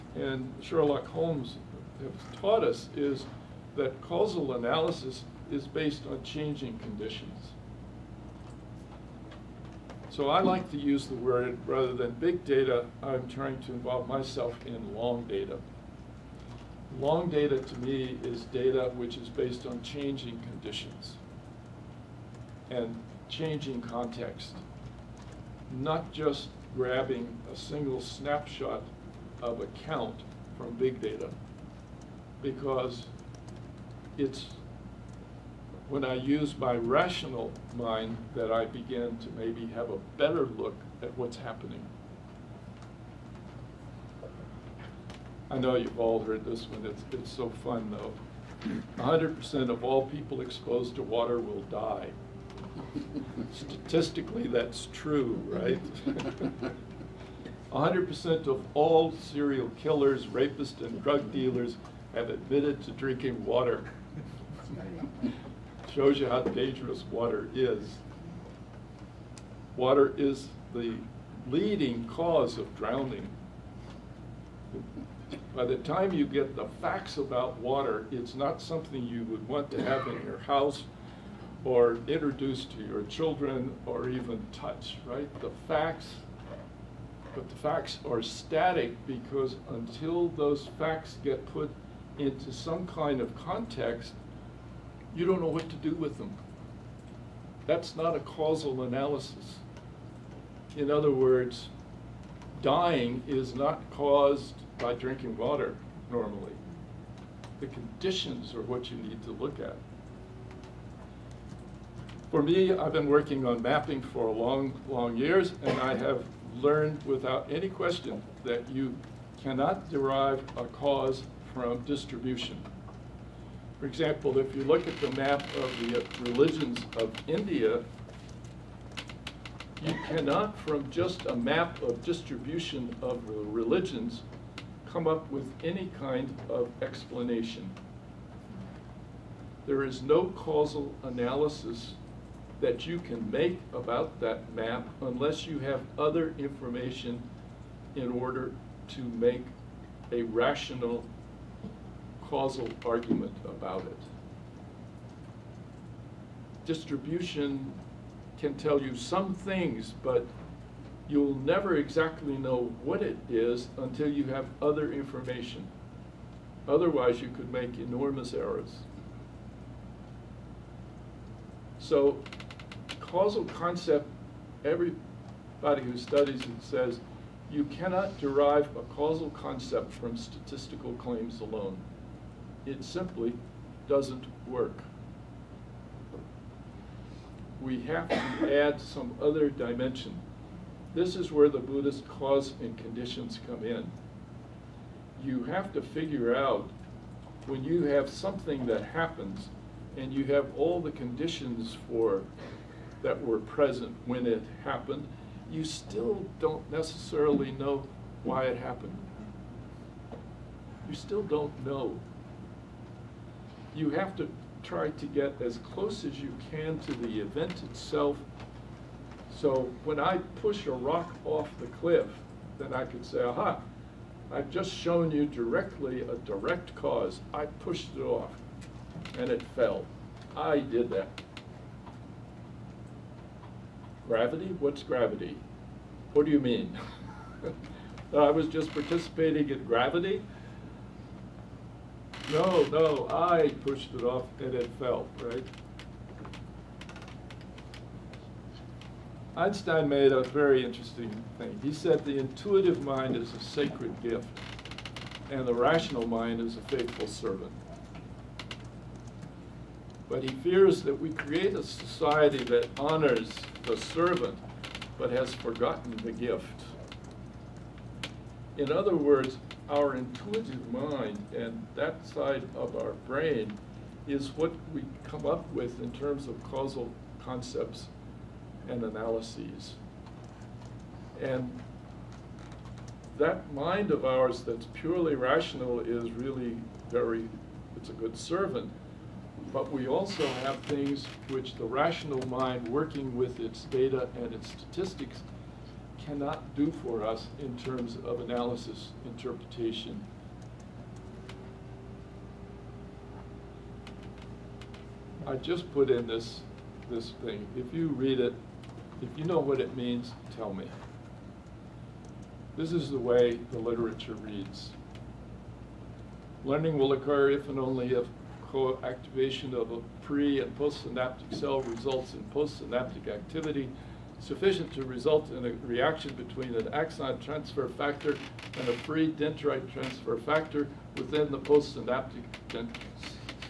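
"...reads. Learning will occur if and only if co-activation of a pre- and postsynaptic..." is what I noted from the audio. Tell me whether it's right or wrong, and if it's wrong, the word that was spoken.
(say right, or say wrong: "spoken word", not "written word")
right.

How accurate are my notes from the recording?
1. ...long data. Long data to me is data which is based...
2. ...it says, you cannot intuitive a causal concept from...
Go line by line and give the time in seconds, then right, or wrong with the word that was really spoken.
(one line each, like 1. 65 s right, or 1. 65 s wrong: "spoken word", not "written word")
1. 14 s right
2. 176 s wrong: "derive", not "intuitive".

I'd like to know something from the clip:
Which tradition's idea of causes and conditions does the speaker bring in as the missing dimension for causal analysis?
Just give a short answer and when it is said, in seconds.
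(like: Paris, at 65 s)
Buddhist, at 191 s.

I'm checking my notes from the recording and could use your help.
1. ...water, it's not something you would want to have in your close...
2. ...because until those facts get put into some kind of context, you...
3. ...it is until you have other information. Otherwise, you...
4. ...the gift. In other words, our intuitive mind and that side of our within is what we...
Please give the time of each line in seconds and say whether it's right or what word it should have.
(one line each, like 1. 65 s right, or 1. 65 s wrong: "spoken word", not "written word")
1. 77 s wrong: "house", not "close"
2. 89 s right
3. 163 s right
4. 266 s wrong: "brain", not "within".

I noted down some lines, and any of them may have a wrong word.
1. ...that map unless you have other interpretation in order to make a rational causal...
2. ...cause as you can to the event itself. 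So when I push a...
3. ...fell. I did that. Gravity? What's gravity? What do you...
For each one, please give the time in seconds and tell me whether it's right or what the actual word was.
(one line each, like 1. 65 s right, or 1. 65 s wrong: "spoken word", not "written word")
1. 144 s wrong: "information", not "interpretation"
2. 215 s wrong: "close", not "cause"
3. 229 s right.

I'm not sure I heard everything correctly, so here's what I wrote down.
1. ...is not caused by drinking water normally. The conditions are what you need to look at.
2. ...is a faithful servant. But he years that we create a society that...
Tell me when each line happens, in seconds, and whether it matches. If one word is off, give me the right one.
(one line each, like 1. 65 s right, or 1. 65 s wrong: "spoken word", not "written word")
1. 103 s right
2. 256 s wrong: "fears", not "years".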